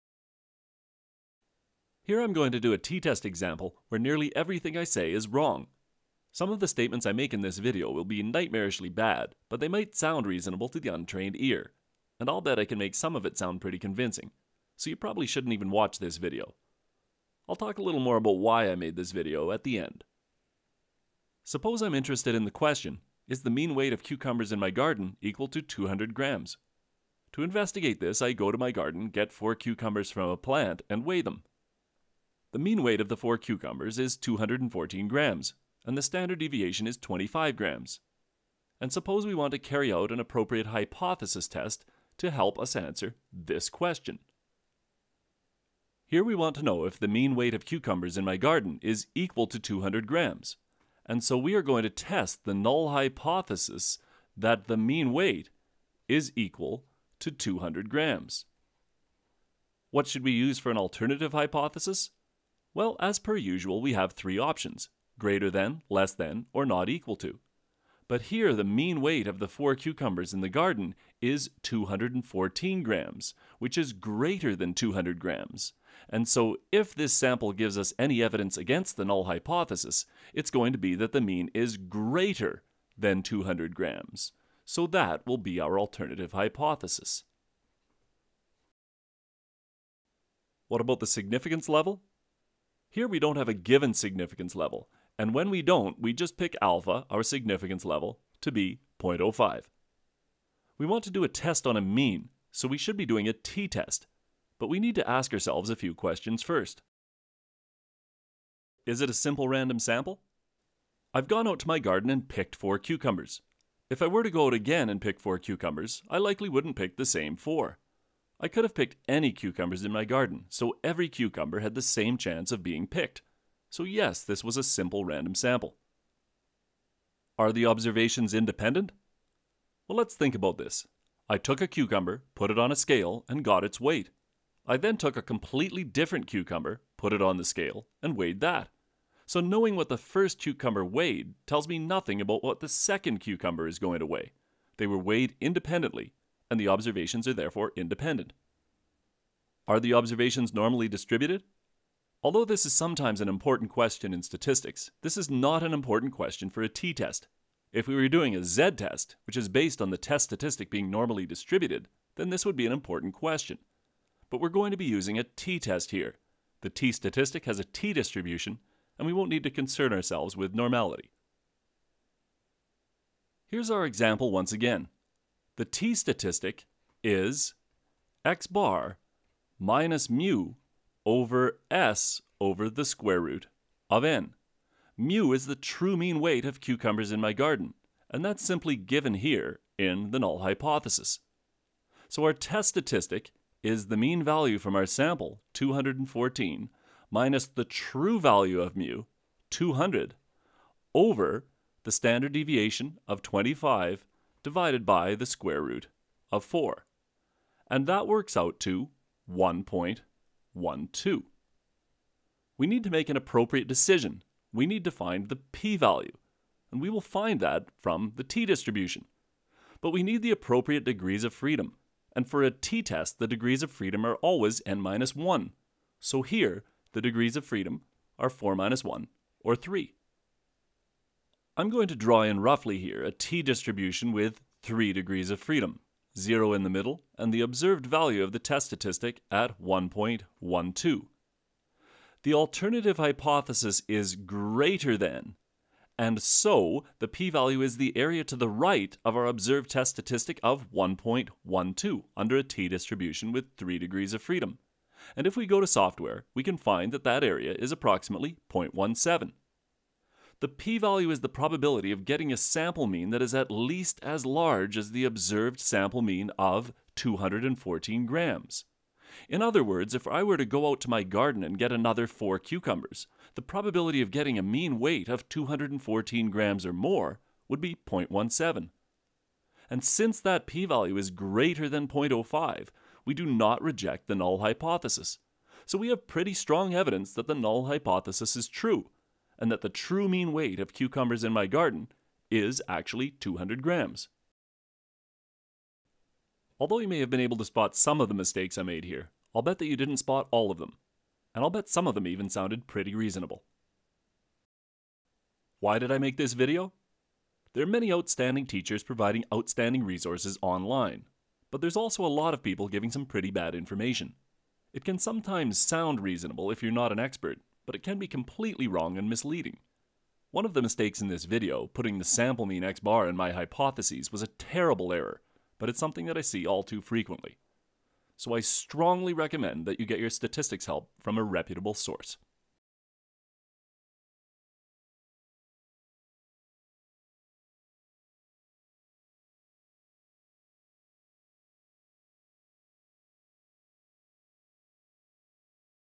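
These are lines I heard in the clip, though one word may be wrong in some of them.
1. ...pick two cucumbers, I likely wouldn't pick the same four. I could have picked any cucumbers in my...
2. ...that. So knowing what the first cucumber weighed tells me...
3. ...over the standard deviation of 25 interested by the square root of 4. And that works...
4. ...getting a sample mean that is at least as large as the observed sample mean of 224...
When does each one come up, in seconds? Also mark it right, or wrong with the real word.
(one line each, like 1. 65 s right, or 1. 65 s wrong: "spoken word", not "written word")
1. 114 s wrong: "four", not "two"
2. 138 s right
3. 200 s wrong: "divided", not "interested"
4. 262 s wrong: "214", not "224".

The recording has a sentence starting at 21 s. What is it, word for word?
Suppose I'm interested in the question, is the mean weight of cucumbers in my garden equal to 200 grams?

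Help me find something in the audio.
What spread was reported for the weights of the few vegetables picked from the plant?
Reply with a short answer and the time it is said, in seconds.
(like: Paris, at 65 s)
25 grams, at 36 s.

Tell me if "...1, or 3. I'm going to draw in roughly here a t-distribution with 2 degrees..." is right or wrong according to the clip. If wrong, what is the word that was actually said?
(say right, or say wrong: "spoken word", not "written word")
wrong: "3", not "2".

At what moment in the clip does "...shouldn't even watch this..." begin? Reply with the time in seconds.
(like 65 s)
15 s.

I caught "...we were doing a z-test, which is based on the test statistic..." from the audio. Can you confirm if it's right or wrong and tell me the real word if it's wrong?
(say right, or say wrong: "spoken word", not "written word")
right.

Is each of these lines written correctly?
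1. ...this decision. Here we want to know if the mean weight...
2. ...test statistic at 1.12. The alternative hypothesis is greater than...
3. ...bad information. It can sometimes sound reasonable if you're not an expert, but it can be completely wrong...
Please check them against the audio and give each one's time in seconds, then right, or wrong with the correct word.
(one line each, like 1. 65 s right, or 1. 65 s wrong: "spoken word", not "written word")
1. 43 s wrong: "question", not "decision"
2. 238 s right
3. 313 s right.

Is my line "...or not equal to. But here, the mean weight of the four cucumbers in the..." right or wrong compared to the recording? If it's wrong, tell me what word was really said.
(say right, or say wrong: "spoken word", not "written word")
right.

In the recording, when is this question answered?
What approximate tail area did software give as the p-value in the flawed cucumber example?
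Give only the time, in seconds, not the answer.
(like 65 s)
257 s.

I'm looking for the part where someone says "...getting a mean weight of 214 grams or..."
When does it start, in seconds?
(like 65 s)
274 s.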